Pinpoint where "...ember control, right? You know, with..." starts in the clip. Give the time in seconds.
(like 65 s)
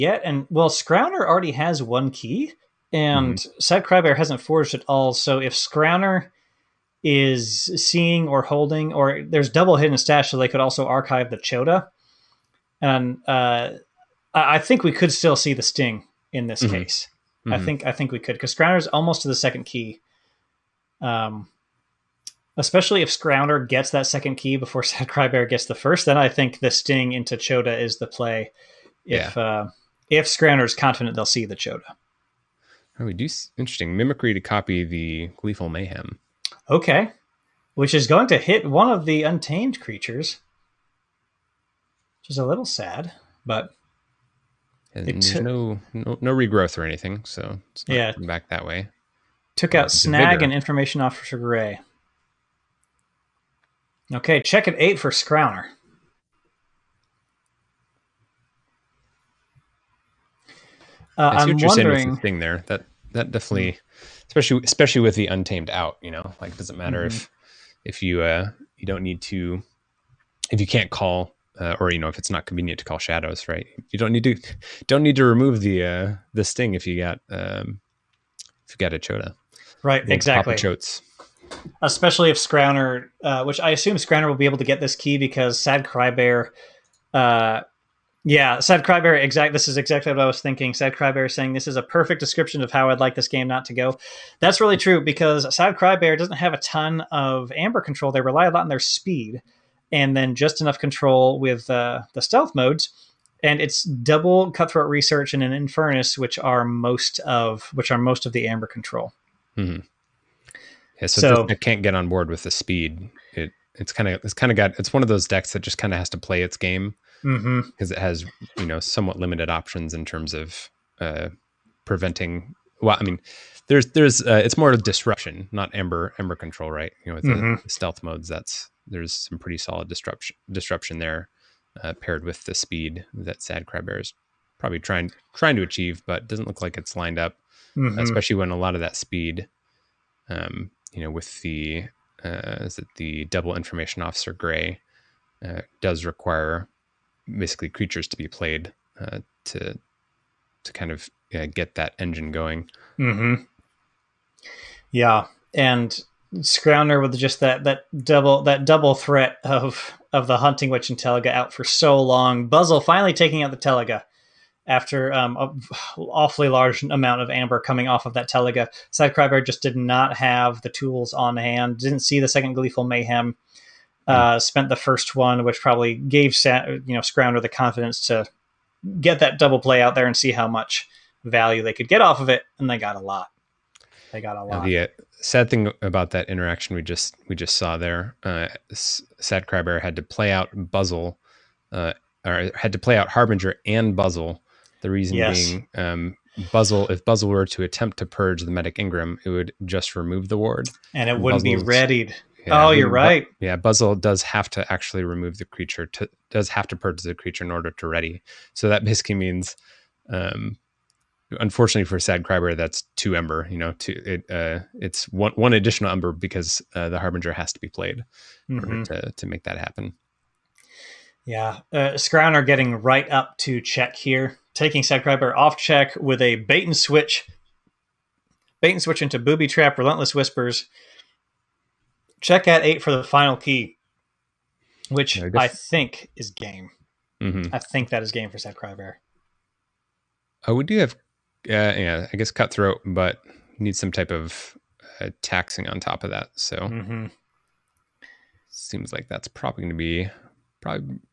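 126 s.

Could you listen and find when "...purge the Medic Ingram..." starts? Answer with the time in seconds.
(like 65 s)
198 s.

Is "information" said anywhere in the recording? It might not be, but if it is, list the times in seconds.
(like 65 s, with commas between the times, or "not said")
50 s, 143 s.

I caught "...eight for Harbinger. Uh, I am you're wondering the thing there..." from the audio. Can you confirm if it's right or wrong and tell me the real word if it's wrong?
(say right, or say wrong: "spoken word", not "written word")
wrong: "Scrowner", not "Harbinger".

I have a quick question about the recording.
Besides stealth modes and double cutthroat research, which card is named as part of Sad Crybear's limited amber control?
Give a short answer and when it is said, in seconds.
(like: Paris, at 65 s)
Infernus, at 105 s.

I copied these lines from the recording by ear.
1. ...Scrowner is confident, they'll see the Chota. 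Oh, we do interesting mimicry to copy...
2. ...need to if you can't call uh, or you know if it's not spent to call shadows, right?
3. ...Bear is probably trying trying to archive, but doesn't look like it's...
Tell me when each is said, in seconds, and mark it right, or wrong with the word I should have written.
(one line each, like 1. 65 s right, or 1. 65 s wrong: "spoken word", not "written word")
1. 30 s right
2. 69 s wrong: "convenient", not "spent"
3. 133 s wrong: "achieve", not "archive".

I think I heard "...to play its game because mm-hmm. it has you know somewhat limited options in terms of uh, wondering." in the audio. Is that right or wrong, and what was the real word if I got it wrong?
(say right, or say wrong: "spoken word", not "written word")
wrong: "preventing", not "wondering".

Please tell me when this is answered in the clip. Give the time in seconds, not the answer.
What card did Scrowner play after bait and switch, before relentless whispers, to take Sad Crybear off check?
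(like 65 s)
229 s.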